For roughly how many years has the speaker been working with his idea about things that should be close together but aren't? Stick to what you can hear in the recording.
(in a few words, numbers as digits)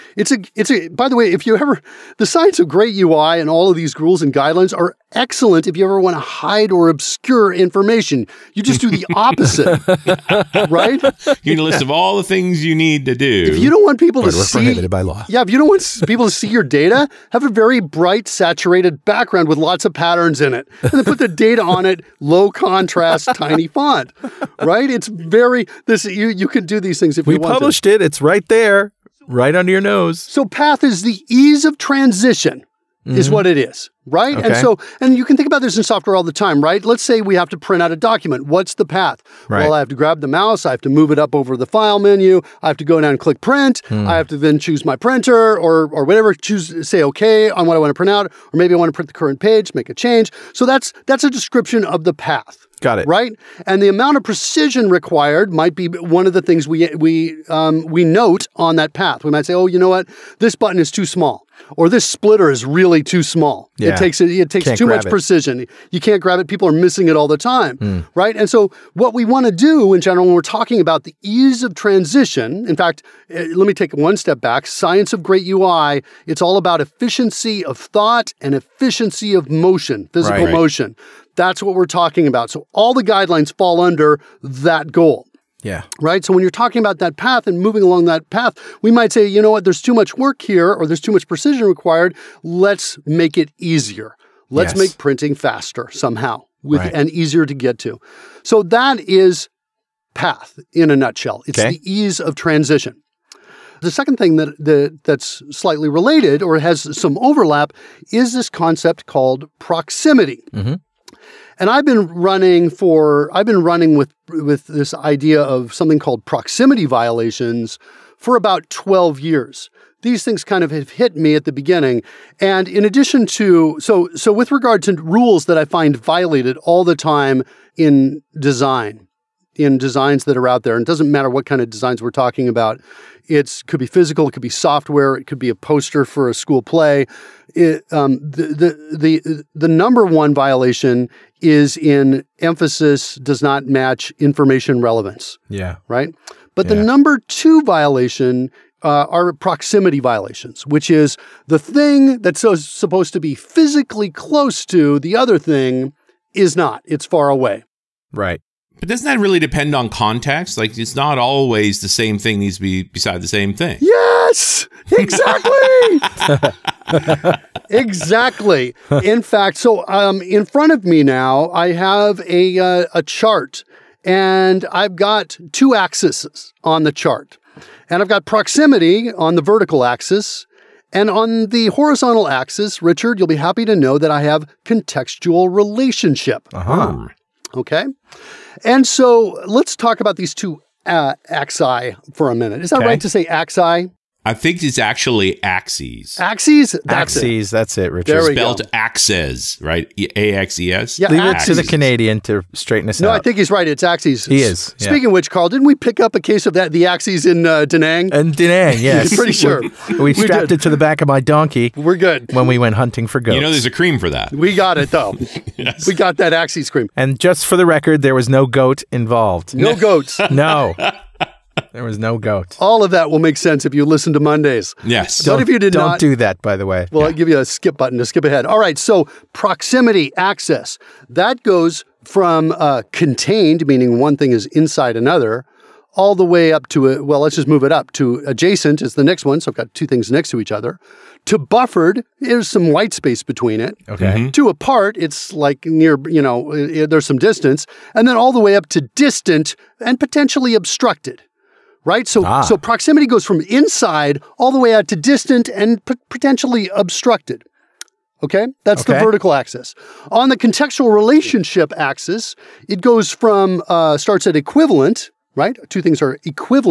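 12.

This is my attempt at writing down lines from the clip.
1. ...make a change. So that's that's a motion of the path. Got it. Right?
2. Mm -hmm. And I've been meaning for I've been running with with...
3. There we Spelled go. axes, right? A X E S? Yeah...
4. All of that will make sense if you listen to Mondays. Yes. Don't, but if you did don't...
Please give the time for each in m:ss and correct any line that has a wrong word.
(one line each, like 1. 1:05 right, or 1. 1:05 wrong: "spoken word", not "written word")
1. 0:49 wrong: "description", not "motion"
2. 1:50 wrong: "running", not "meaning"
3. 3:18 right
4. 3:42 right.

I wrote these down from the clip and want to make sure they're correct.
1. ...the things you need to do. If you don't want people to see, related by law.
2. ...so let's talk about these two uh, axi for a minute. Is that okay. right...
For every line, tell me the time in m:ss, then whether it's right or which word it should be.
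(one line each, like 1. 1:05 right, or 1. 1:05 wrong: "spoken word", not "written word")
1. 0:12 wrong: "prohibited", not "related"
2. 3:08 right.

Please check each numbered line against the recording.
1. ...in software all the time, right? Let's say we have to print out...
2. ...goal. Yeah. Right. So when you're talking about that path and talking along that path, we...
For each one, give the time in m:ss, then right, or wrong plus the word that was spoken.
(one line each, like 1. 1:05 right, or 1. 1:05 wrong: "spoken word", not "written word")
1. 0:35 right
2. 1:24 wrong: "moving", not "talking".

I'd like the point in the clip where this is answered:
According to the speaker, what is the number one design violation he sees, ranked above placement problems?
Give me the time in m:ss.
2:22.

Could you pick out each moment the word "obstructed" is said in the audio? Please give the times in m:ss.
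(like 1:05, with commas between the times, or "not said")
4:10, 4:16.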